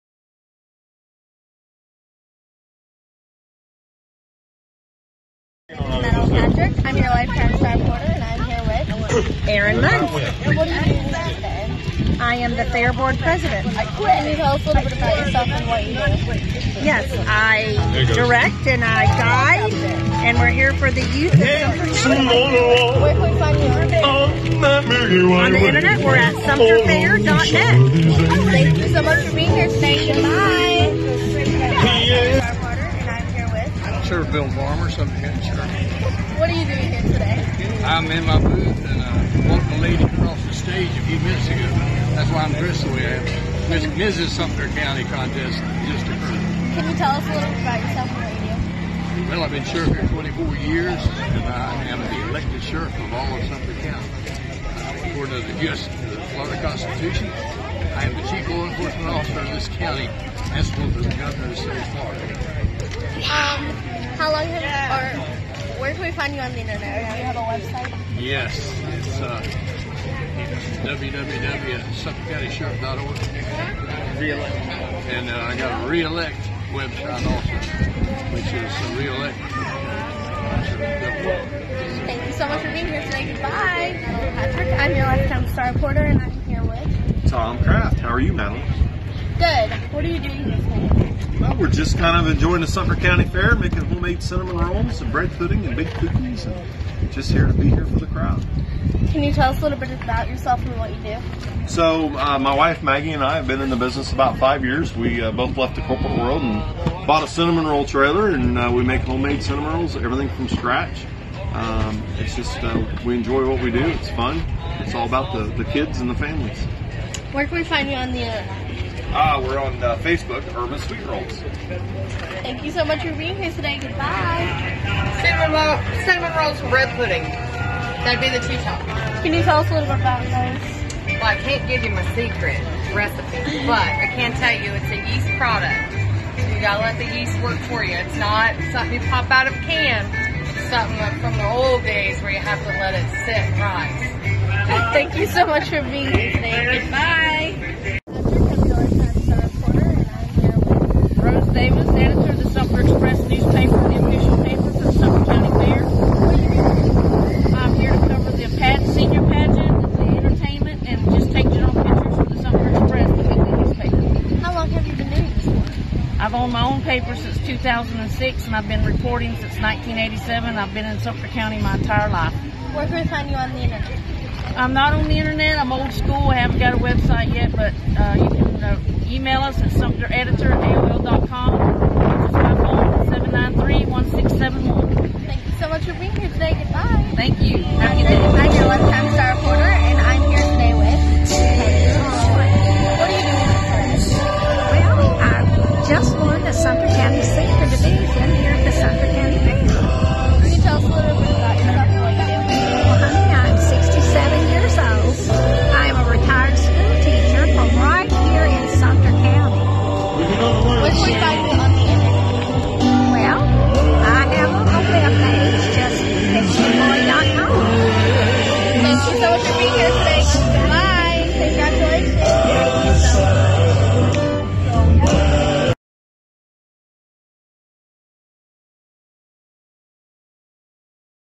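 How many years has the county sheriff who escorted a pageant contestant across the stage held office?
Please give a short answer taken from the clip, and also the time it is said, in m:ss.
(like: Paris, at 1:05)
24, at 0:50.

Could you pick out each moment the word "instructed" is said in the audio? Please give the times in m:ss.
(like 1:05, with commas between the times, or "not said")
not said.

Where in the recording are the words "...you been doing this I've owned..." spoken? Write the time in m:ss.
2:44.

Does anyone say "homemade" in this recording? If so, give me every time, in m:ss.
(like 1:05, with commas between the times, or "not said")
1:33, 1:49.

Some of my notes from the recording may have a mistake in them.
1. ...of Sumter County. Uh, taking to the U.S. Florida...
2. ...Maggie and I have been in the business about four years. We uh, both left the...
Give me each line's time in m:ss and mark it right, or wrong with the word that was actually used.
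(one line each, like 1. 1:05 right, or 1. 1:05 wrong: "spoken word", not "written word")
1. 0:53 wrong: "according", not "taking"
2. 1:42 wrong: "five", not "four".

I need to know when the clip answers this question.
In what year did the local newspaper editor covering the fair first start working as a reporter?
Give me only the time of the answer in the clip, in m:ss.
2:49.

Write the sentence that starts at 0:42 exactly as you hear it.
That's why I'm dressed the way I am.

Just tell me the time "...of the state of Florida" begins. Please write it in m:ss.
1:01.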